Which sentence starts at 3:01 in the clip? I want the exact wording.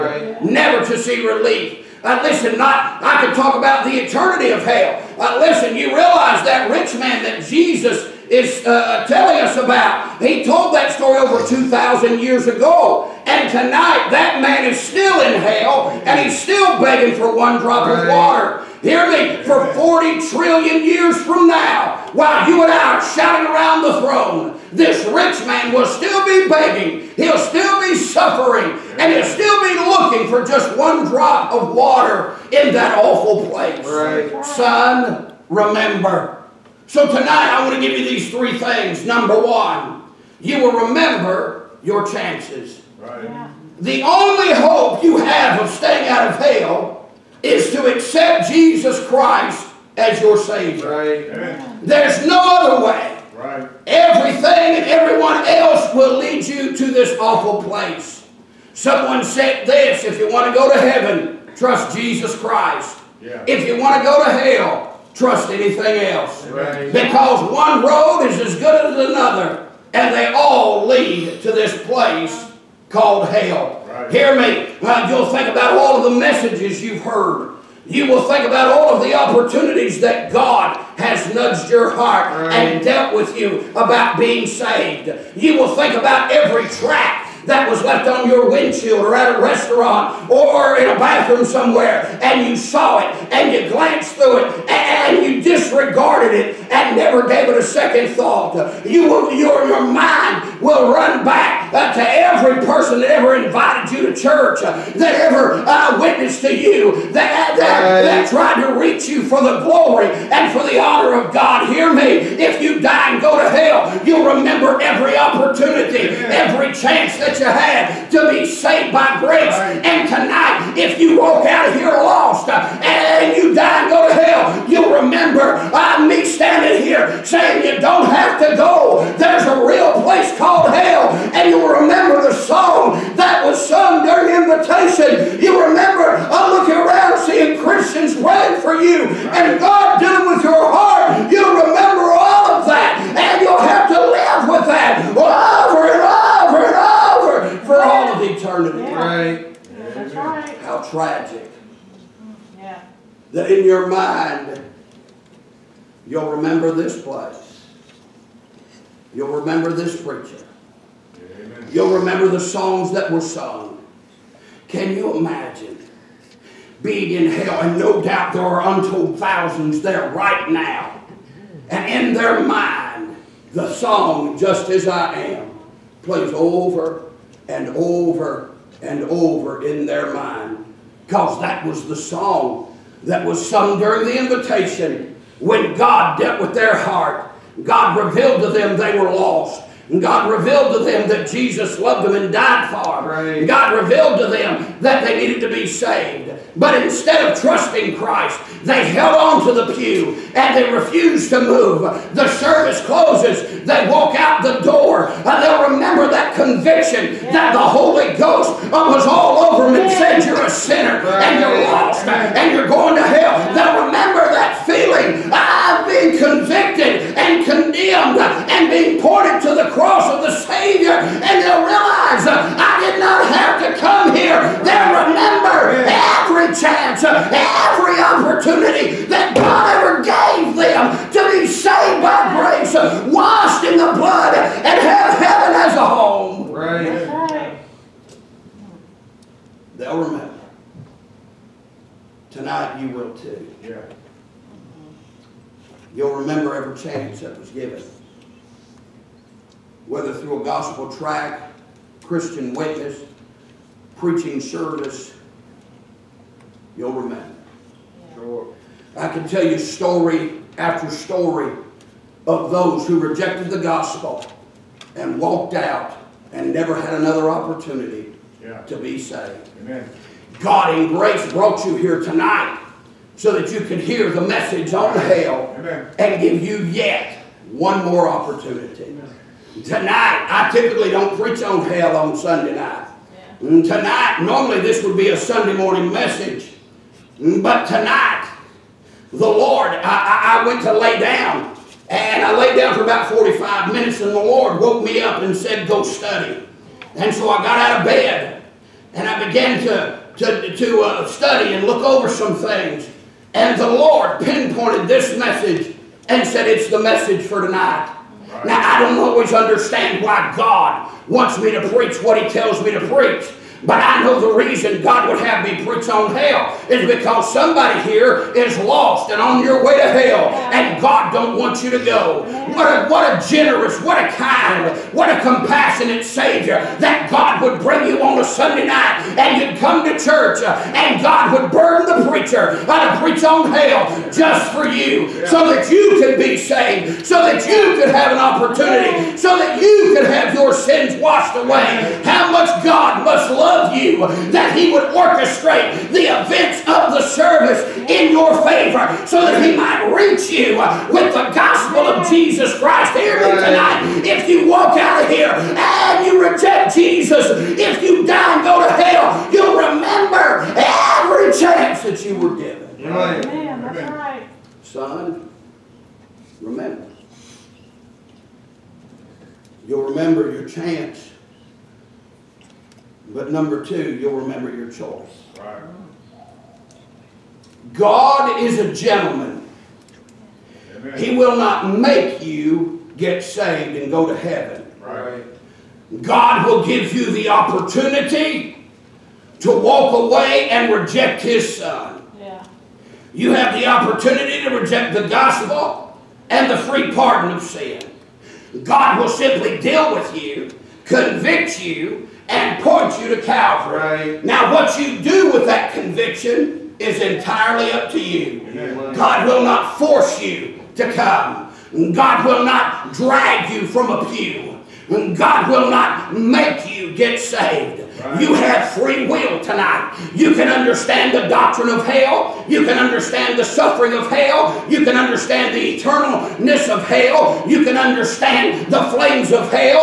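Because that was the song that was sung during the invitation when God dealt with their heart.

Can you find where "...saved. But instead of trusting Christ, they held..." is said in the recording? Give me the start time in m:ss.
3:15.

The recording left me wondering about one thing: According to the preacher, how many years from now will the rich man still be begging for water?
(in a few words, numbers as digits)
40 trillion.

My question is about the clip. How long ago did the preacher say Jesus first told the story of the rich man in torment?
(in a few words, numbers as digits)
over 2,000 years.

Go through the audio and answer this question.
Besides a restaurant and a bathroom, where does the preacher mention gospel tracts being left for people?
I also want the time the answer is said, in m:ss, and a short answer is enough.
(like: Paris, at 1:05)
windshield, at 1:28.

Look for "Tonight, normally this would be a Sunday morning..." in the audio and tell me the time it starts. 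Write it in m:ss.
4:43.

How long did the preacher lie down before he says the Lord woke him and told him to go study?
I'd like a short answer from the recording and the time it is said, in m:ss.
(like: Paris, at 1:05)
45 minutes, at 4:53.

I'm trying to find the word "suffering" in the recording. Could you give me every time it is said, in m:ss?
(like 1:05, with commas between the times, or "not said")
0:27, 7:03.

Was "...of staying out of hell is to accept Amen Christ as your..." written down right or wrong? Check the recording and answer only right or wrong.
wrong.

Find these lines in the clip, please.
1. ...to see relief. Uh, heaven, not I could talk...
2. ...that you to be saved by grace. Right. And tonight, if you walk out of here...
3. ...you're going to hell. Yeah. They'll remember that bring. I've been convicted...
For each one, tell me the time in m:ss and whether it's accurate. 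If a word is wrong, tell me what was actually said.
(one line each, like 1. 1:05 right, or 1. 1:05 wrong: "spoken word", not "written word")
1. 0:00 wrong: "listen", not "heaven"
2. 1:57 right
3. 3:32 wrong: "feeling", not "bring".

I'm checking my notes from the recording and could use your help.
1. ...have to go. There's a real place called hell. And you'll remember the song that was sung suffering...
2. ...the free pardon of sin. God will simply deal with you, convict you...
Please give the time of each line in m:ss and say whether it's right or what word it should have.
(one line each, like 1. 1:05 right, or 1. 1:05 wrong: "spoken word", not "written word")
1. 2:08 wrong: "during", not "suffering"
2. 6:36 right.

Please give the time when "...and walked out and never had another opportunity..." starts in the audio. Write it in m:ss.
4:24.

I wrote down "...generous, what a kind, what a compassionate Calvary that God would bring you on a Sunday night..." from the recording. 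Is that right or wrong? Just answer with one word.
wrong.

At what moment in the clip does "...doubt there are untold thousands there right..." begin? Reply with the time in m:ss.
2:48.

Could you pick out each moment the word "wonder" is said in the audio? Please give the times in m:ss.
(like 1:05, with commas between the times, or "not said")
not said.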